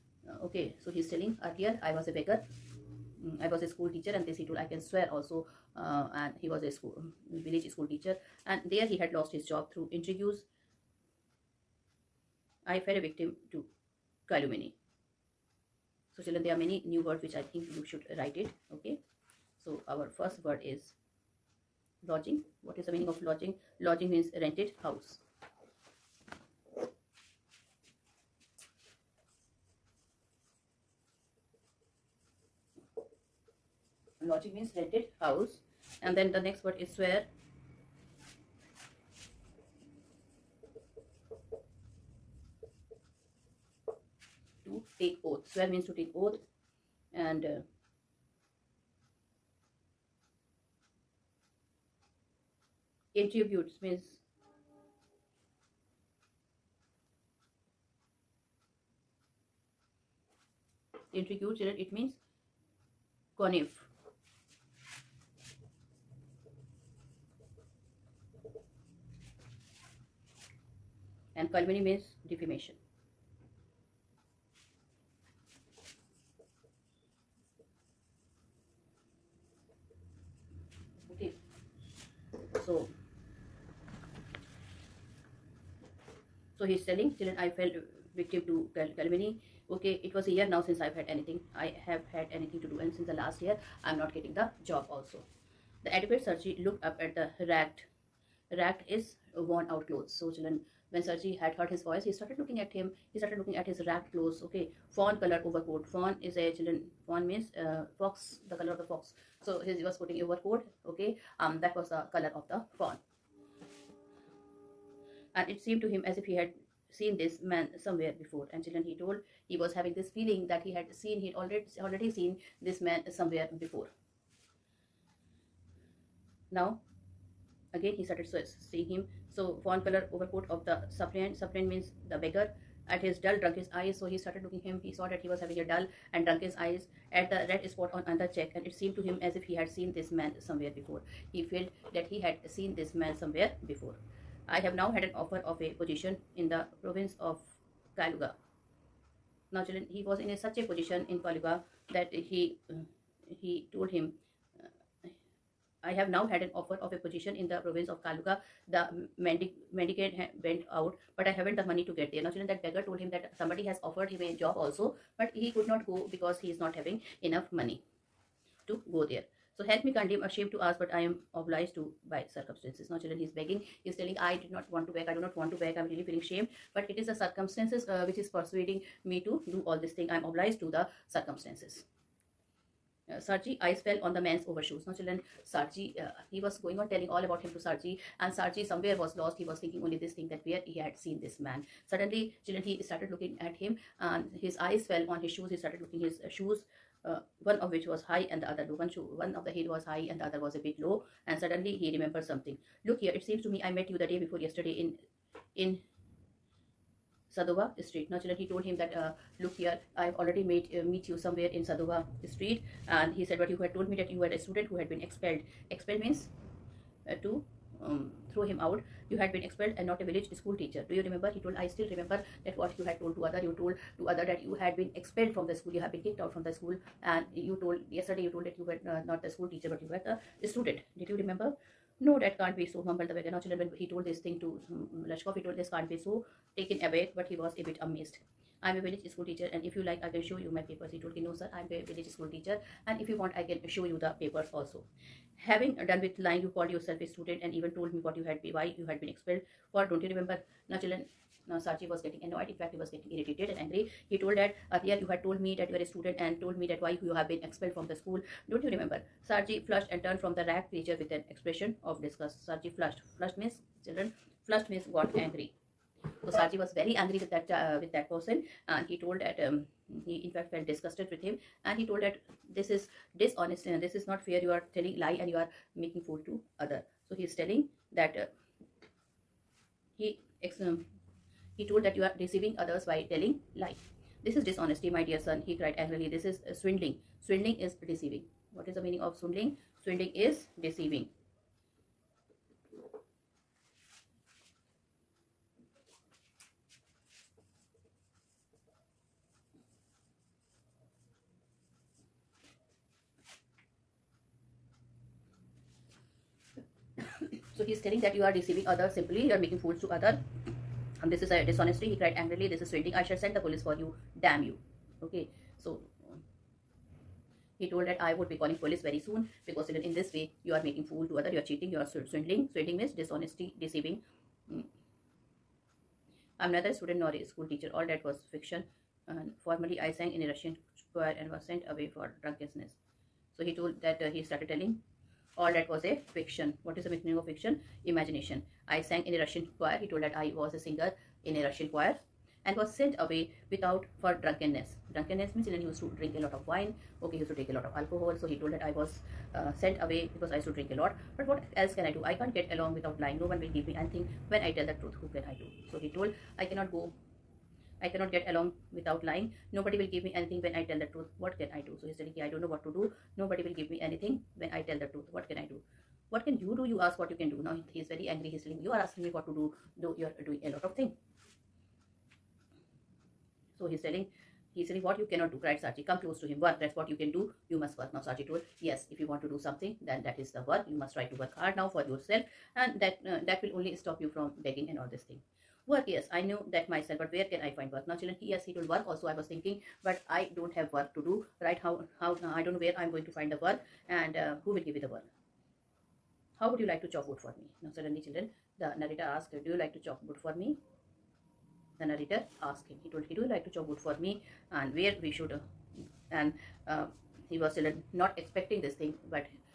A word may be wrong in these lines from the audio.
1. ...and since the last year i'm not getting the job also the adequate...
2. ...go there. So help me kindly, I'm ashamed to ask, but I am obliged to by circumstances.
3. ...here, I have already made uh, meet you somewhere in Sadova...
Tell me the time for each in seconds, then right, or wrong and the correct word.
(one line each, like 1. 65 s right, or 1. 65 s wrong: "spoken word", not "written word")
1. 92 s right
2. 168 s right
3. 209 s right.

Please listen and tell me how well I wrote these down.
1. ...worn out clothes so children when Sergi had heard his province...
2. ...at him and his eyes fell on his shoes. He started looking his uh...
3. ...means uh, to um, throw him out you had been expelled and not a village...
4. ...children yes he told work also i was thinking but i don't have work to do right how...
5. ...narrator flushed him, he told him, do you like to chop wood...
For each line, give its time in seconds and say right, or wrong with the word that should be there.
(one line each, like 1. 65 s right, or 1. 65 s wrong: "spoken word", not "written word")
1. 99 s wrong: "voice", not "province"
2. 193 s right
3. 216 s right
4. 387 s right
5. 401 s wrong: "asked", not "flushed".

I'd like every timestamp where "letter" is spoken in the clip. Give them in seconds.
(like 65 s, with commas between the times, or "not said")
not said.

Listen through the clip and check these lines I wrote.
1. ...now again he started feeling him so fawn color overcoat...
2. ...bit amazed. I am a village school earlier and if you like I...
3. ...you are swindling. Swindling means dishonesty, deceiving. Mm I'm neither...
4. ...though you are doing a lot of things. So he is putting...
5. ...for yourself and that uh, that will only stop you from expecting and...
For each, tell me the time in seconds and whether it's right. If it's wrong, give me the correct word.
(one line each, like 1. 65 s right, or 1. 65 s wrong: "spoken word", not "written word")
1. 126 s wrong: "seeing", not "feeling"
2. 237 s wrong: "teacher", not "earlier"
3. 321 s right
4. 369 s wrong: "telling", not "putting"
5. 381 s wrong: "begging", not "expecting".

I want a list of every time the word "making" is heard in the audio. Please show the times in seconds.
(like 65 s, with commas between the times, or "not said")
275 s, 309 s, 320 s.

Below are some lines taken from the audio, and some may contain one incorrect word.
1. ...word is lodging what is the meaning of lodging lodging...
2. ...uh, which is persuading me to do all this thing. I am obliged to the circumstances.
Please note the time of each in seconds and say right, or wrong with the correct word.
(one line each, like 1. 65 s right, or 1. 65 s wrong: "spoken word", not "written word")
1. 20 s right
2. 177 s right.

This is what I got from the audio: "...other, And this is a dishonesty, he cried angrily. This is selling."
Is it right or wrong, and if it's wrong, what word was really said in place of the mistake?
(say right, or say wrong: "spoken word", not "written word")
wrong: "swindling", not "selling".